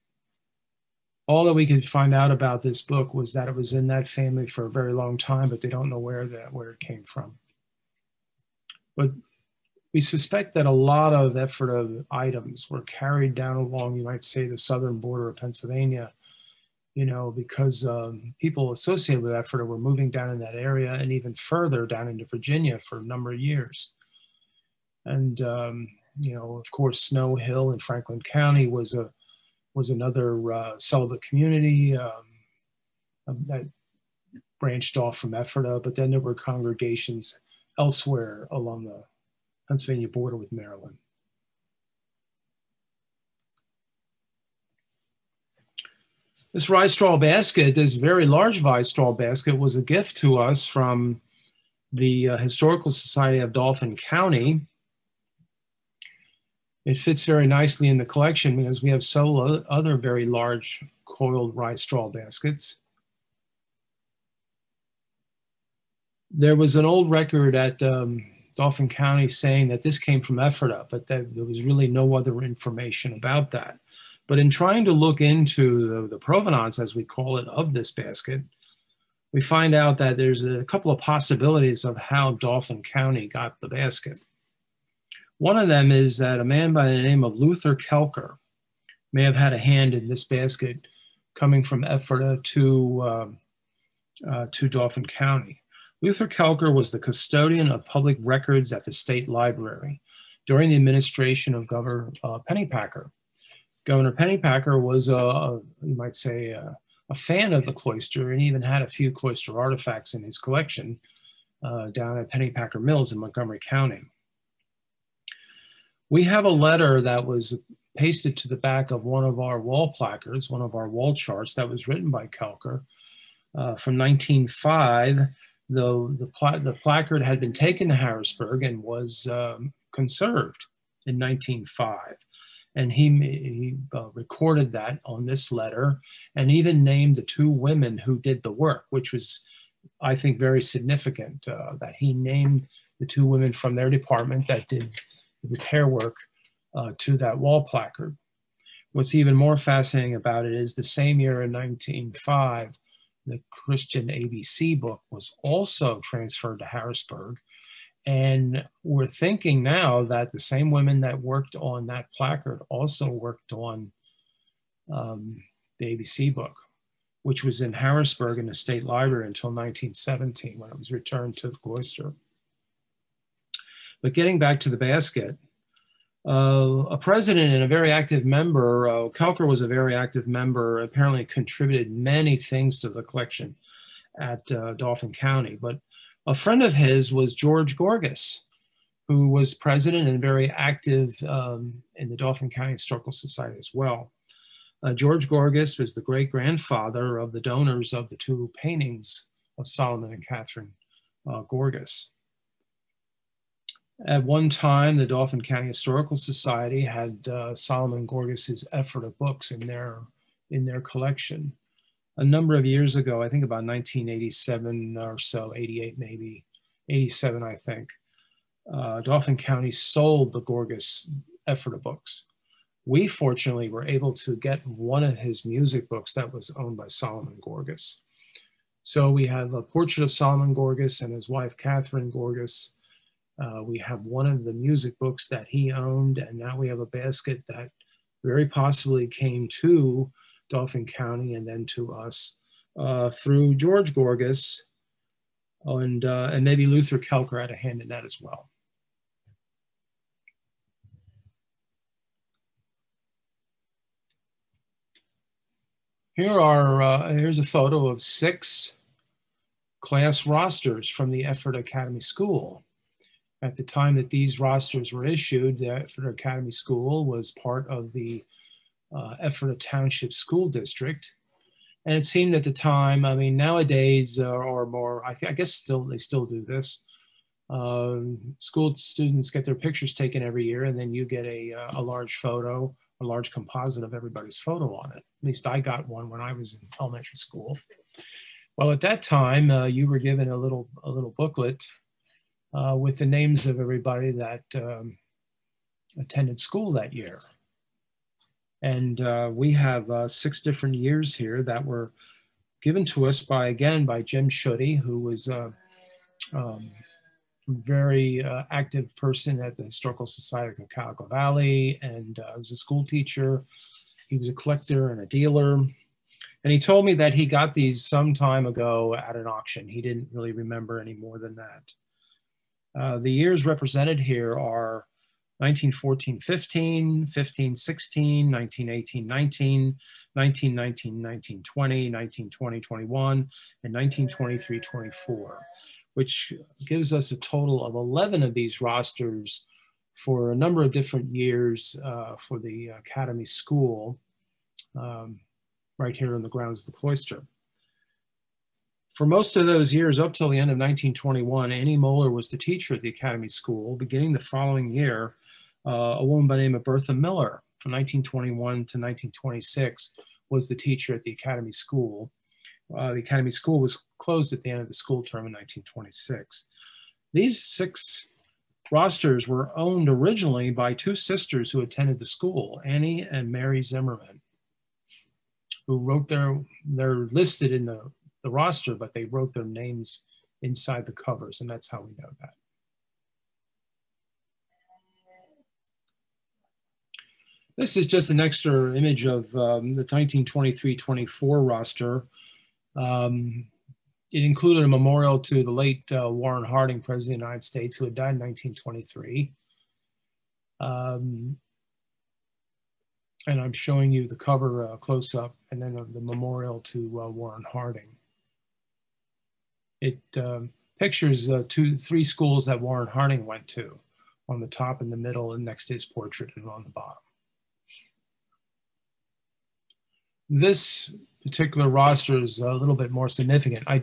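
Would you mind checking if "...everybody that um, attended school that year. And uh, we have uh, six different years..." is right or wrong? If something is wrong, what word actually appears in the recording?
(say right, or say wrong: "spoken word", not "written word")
right.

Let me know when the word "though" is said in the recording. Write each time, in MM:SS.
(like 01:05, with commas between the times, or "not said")
02:05.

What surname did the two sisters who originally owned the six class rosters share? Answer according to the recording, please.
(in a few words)
Zimmerman.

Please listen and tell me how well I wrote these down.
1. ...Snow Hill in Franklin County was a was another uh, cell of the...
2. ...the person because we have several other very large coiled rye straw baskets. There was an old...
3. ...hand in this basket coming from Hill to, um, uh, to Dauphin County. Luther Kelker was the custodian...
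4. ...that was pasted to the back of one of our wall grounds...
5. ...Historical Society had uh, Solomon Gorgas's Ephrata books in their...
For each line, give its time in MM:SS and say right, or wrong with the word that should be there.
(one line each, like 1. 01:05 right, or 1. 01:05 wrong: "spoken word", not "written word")
1. 00:27 right
2. 00:57 wrong: "collection", not "person"
3. 01:29 wrong: "Ephrata", not "Hill"
4. 01:57 wrong: "placards", not "grounds"
5. 03:25 right.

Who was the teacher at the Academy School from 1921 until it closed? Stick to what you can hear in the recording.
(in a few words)
Bertha Miller.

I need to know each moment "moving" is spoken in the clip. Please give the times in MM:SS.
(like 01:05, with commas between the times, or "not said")
00:19.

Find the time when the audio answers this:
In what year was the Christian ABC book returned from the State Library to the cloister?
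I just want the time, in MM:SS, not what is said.
02:49.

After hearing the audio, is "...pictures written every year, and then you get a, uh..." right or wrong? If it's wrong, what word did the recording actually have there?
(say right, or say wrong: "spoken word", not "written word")
wrong: "taken", not "written".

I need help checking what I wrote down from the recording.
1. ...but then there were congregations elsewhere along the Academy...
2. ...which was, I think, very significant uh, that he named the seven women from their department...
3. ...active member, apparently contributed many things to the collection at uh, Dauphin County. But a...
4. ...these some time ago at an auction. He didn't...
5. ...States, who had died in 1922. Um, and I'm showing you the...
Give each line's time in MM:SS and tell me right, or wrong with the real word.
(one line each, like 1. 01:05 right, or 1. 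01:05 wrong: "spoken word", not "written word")
1. 00:35 wrong: "Pennsylvania", not "Academy"
2. 02:18 wrong: "two", not "seven"
3. 02:59 right
4. 05:17 right
5. 06:37 wrong: "1923", not "1922".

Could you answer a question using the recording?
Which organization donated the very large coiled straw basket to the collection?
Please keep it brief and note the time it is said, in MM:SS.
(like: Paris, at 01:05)
Historical Society of Dauphin County, at 00:52.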